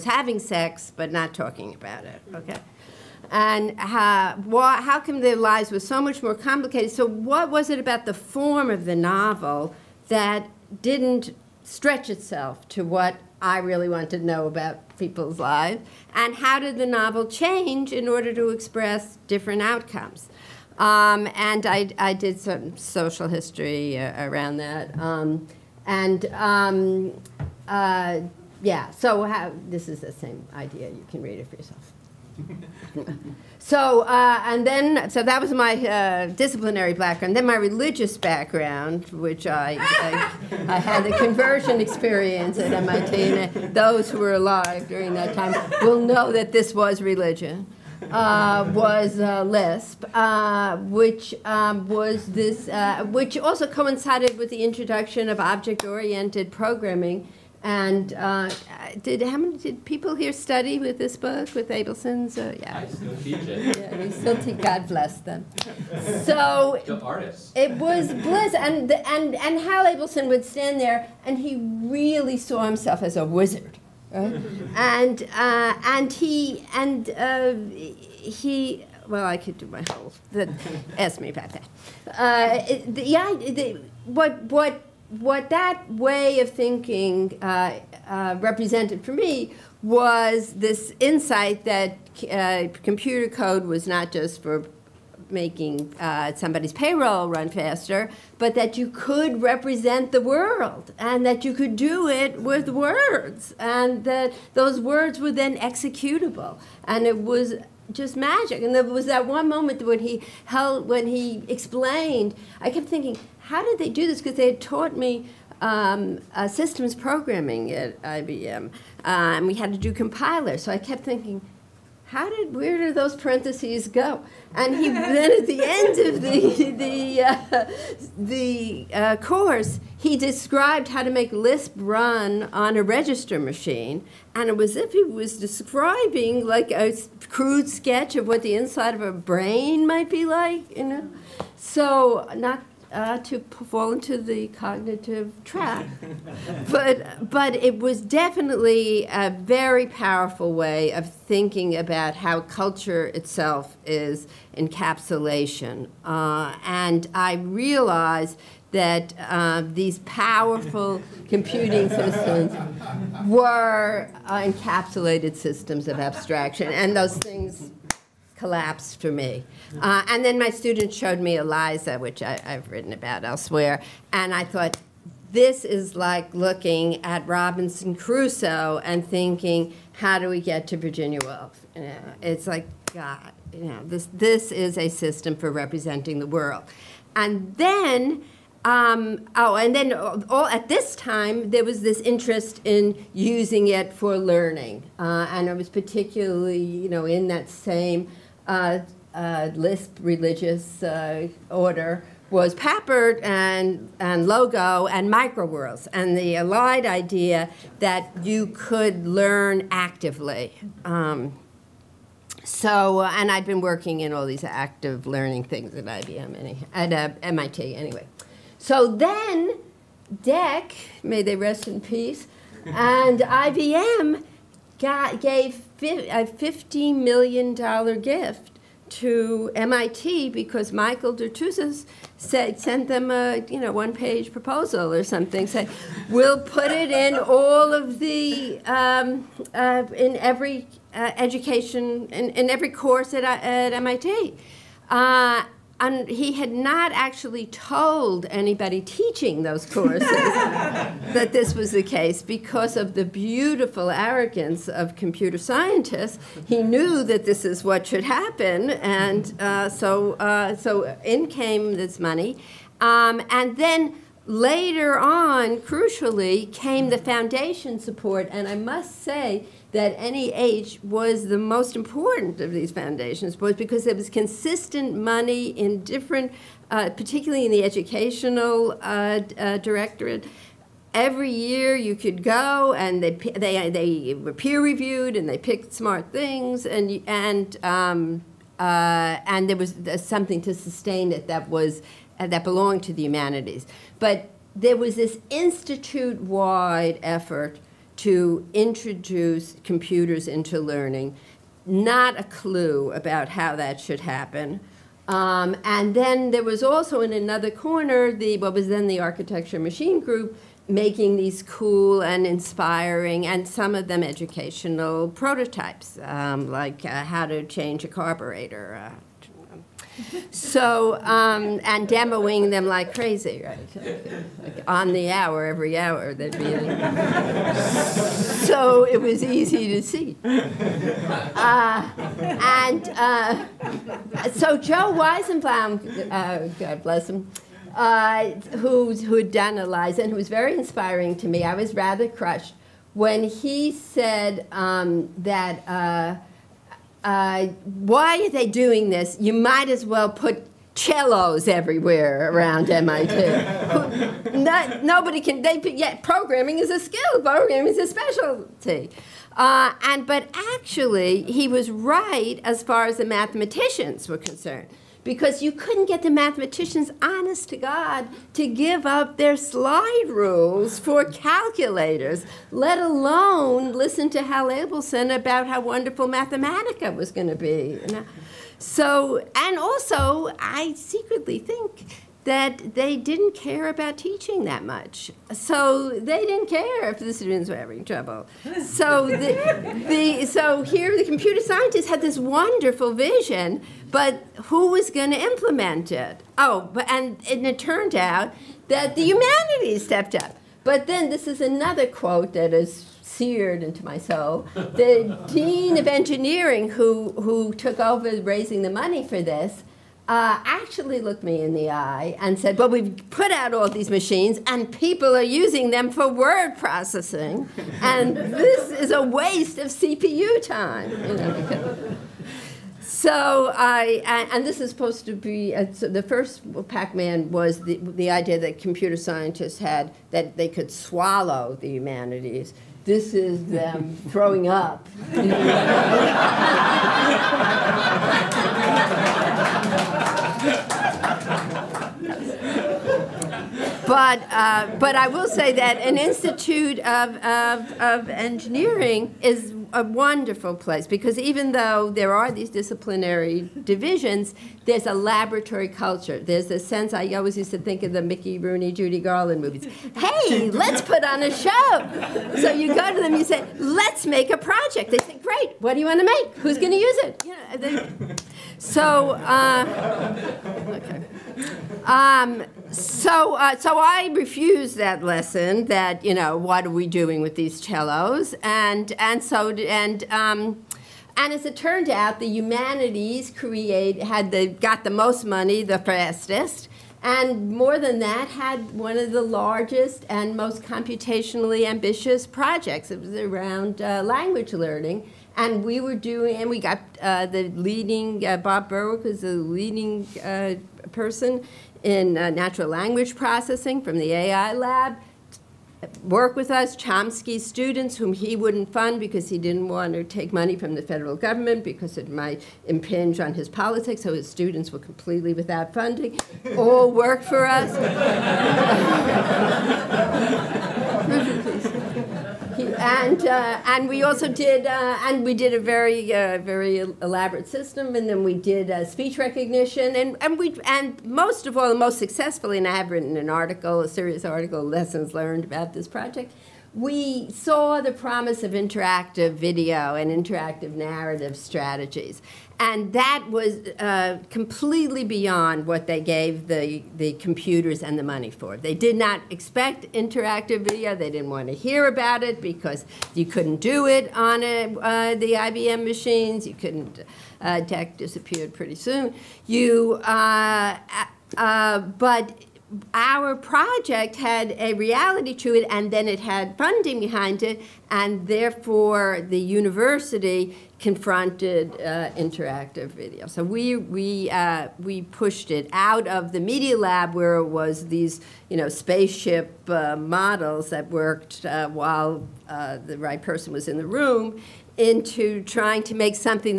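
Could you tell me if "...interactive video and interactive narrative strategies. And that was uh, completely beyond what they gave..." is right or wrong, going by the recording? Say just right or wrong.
right.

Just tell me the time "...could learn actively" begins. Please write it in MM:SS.
03:28.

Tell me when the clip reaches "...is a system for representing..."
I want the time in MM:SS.
03:04.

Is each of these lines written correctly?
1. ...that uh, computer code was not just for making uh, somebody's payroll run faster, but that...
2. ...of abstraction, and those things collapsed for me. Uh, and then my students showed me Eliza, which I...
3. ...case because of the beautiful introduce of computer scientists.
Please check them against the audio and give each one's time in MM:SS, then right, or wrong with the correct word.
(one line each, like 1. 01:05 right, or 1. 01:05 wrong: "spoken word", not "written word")
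1. 01:31 right
2. 02:45 right
3. 04:11 wrong: "arrogance", not "introduce".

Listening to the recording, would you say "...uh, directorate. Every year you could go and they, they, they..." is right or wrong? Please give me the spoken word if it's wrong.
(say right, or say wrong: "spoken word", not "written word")
right.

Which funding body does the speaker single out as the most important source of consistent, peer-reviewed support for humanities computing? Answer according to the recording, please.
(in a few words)
NEH.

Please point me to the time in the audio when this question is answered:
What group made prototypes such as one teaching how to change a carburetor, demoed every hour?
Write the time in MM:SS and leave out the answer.
05:09.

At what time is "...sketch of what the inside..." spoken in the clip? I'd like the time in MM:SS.
02:17.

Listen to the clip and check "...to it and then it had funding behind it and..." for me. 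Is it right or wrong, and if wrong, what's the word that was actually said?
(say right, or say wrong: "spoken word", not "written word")
right.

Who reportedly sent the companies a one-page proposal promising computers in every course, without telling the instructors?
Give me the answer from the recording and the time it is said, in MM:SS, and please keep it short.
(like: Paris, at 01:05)
Michael Dertouzos, at 03:50.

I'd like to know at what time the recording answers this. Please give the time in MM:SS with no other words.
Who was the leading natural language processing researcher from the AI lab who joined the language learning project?
08:18.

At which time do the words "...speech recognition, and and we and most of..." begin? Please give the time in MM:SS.
08:48.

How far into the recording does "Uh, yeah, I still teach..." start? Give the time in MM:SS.
01:02.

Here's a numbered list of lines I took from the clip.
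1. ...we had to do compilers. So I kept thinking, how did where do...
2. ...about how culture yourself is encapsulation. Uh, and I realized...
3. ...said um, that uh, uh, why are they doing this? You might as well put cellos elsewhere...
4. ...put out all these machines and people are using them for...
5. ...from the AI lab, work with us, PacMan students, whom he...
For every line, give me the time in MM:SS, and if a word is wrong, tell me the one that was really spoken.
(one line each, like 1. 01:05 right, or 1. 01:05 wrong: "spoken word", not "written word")
1. 01:59 right
2. 02:31 wrong: "itself", not "yourself"
3. 05:43 wrong: "everywhere", not "elsewhere"
4. 06:53 right
5. 08:23 wrong: "Chomsky", not "PacMan".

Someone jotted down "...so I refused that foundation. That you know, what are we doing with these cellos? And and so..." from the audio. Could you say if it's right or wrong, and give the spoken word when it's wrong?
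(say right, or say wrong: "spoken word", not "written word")
wrong: "lesson", not "foundation".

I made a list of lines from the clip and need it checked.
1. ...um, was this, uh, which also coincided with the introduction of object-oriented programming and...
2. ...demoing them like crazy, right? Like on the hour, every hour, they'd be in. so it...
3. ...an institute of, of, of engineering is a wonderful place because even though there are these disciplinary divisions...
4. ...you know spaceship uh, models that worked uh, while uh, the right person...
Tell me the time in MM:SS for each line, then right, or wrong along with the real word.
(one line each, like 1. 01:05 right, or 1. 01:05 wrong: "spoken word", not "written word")
1. 00:51 right
2. 05:21 right
3. 07:25 right
4. 09:38 right.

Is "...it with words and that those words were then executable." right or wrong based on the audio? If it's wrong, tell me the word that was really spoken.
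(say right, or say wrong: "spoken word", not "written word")
right.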